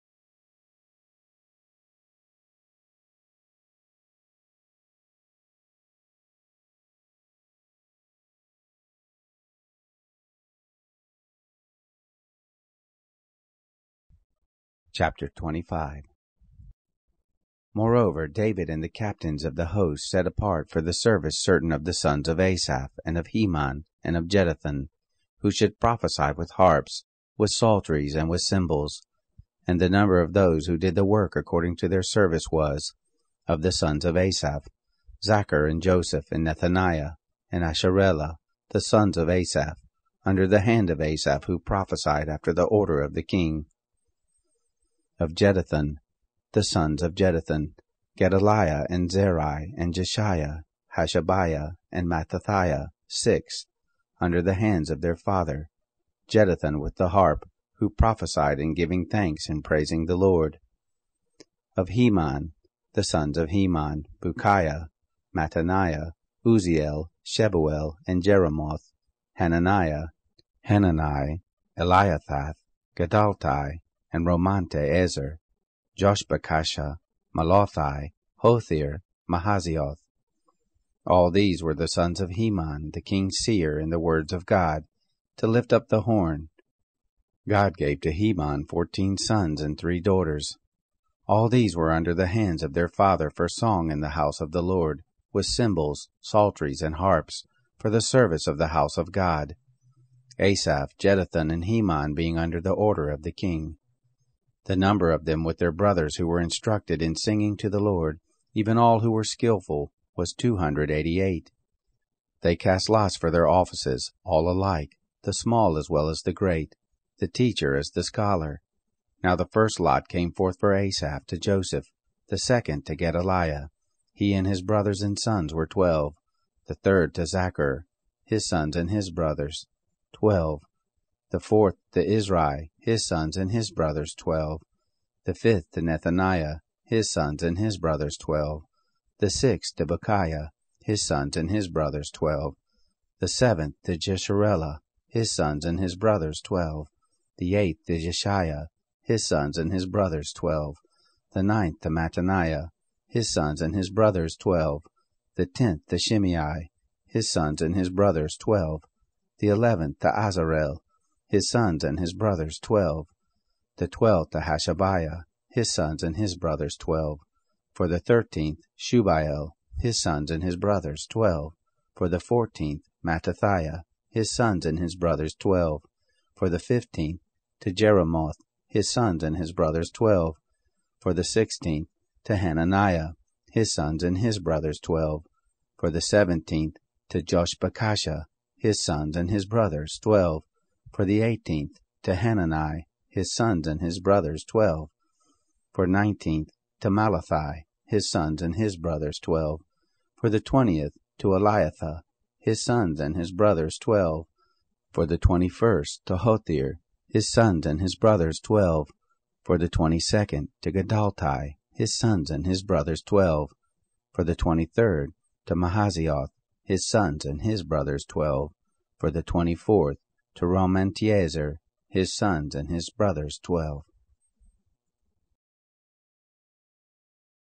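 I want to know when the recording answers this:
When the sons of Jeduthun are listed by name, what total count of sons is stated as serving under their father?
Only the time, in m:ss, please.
0:53.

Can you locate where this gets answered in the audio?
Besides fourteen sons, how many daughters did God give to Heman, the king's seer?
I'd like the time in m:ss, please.
1:29.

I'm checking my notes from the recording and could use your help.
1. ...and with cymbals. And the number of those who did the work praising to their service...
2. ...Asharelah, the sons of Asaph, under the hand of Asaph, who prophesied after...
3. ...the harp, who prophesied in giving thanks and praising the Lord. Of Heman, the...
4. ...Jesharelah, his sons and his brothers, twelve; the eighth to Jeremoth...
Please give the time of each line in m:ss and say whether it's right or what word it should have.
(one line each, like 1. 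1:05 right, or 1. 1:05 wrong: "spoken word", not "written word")
1. 0:28 wrong: "according", not "praising"
2. 0:37 right
3. 0:56 right
4. 2:23 wrong: "Jeshaiah", not "Jeremoth".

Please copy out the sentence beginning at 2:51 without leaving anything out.
For the fourteenth Mattithiah, his sons and his brothers twelve.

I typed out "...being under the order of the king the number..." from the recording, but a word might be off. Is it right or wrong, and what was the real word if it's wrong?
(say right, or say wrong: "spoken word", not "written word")
right.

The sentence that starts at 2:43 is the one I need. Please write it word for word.
The twelfth Hashabiah, his sons and his brothers twelve.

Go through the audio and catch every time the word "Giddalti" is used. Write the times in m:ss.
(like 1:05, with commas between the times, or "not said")
1:12, 3:30.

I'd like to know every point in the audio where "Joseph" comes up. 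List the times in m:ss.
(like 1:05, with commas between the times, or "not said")
0:35, 2:01.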